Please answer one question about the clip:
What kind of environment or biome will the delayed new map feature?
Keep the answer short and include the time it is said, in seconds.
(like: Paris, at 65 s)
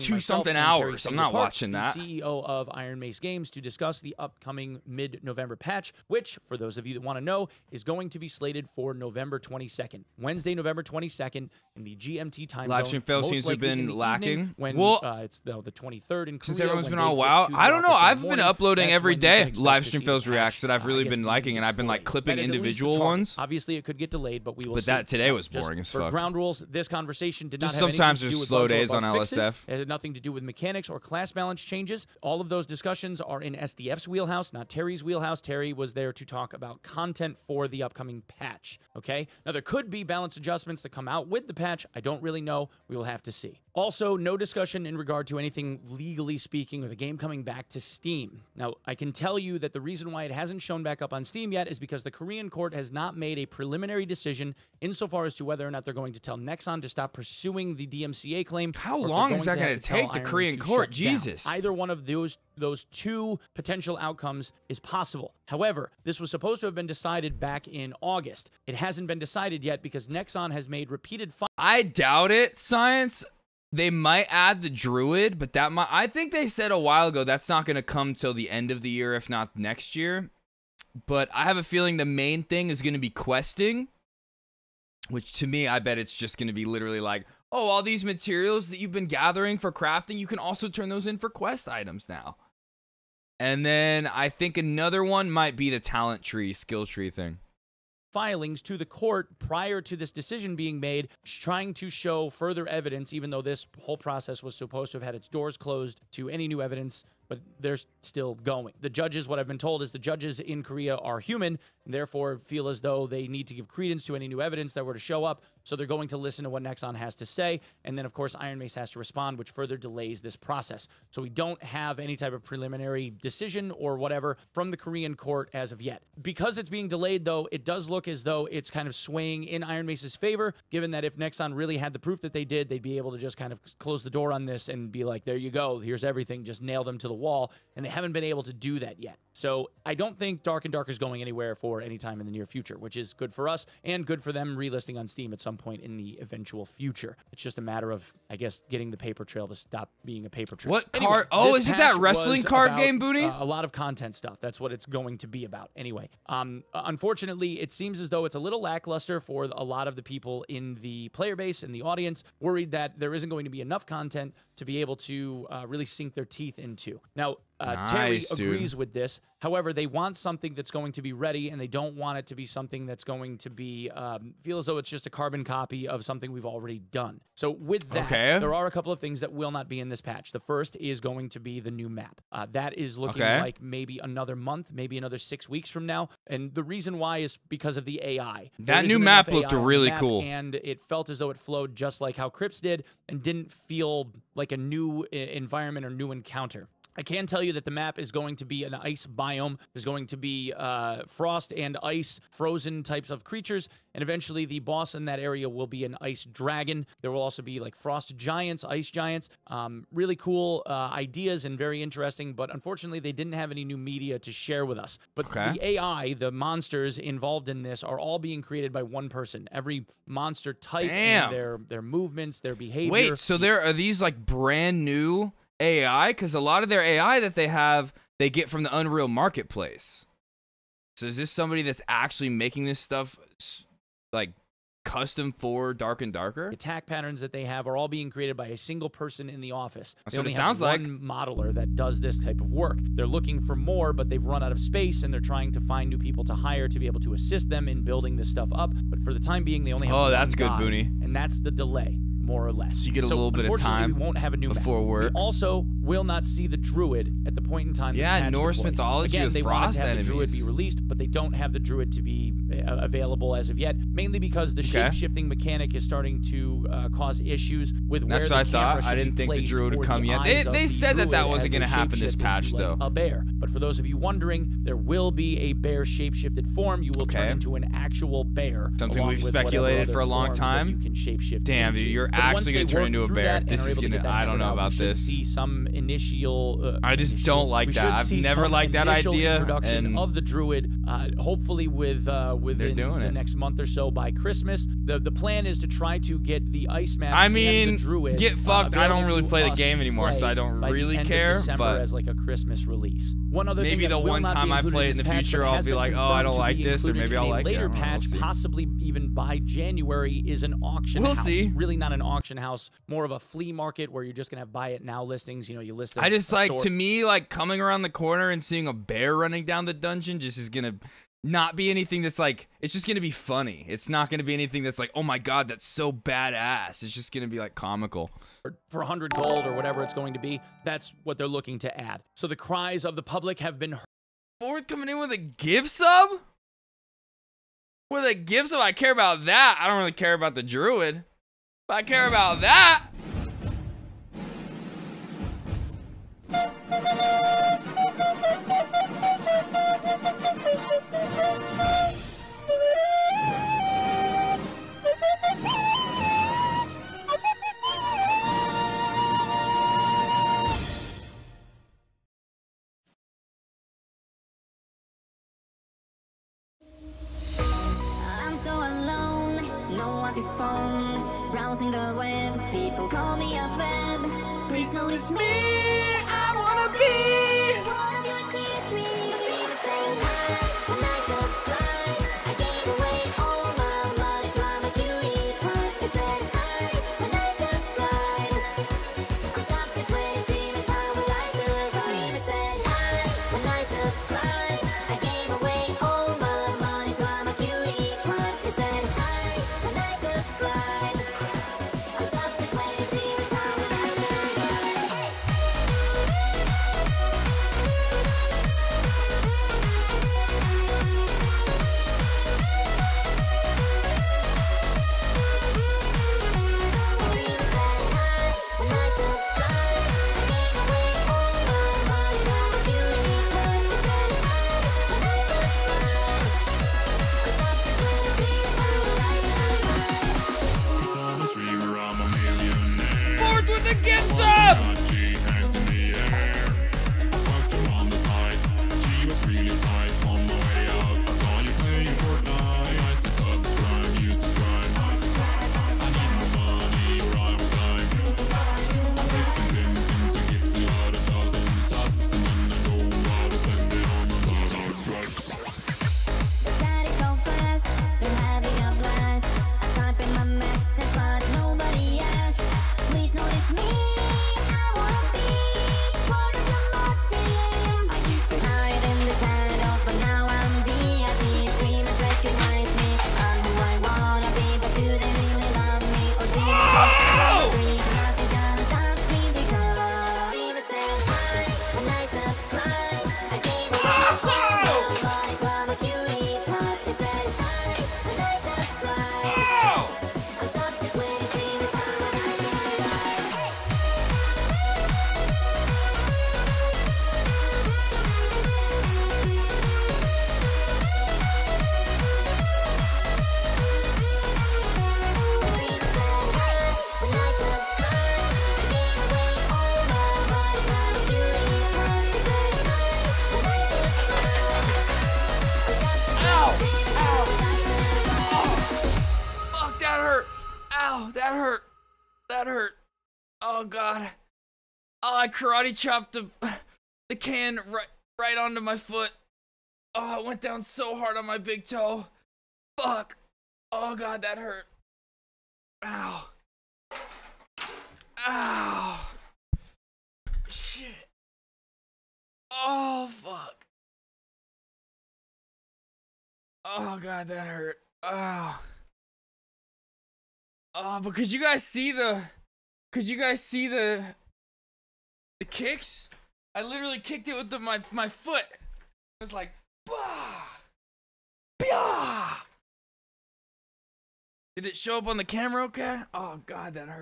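ice biome, at 198 s.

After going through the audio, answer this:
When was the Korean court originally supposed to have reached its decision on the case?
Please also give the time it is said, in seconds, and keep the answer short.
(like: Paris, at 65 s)
August, at 68 s.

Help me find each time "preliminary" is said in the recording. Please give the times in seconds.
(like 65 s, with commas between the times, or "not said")
53 s, 122 s.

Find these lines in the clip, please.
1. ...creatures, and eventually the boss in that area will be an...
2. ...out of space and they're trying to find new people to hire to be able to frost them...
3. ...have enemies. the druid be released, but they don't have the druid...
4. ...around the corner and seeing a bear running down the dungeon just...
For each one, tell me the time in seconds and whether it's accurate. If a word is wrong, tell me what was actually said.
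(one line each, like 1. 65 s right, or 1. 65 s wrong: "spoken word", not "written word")
1. 203 s right
2. 244 s wrong: "assist", not "frost"
3. 259 s right
4. 317 s right.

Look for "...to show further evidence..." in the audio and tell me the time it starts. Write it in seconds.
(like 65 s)
101 s.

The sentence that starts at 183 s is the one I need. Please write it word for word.
like maybe another month, maybe another six weeks from now.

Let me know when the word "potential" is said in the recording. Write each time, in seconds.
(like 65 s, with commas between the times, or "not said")
63 s.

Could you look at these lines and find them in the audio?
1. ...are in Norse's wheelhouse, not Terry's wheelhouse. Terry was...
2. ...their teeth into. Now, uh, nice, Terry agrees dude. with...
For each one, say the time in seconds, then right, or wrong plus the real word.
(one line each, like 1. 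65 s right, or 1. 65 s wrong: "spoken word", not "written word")
1. 33 s wrong: "SDF", not "Norse"
2. 166 s right.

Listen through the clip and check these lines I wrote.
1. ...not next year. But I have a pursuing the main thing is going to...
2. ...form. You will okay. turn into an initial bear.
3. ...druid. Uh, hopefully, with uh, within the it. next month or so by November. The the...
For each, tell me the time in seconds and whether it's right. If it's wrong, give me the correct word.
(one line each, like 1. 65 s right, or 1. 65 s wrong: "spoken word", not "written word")
1. 79 s wrong: "feeling", not "pursuing"
2. 276 s wrong: "actual", not "initial"
3. 290 s wrong: "Christmas", not "November".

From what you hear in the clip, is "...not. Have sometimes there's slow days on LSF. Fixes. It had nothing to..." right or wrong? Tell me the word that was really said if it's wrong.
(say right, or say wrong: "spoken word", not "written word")
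right.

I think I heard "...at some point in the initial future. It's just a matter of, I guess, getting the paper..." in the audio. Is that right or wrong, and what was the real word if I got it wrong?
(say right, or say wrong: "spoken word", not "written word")
wrong: "eventual", not "initial".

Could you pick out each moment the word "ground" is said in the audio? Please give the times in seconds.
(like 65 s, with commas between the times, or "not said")
26 s.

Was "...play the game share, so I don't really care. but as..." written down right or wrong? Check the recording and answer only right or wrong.
wrong.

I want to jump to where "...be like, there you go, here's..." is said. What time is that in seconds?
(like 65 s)
134 s.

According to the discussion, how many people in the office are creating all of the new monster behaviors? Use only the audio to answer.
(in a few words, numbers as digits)
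1.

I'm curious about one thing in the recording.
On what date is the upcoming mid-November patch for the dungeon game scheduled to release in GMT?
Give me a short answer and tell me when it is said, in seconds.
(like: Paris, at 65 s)
November 22nd, at 10 s.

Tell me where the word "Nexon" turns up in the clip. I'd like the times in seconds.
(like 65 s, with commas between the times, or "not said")
56 s, 70 s, 116 s, 131 s.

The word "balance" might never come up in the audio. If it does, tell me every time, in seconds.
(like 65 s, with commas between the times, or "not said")
31 s, 40 s.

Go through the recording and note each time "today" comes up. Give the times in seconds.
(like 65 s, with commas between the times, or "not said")
25 s.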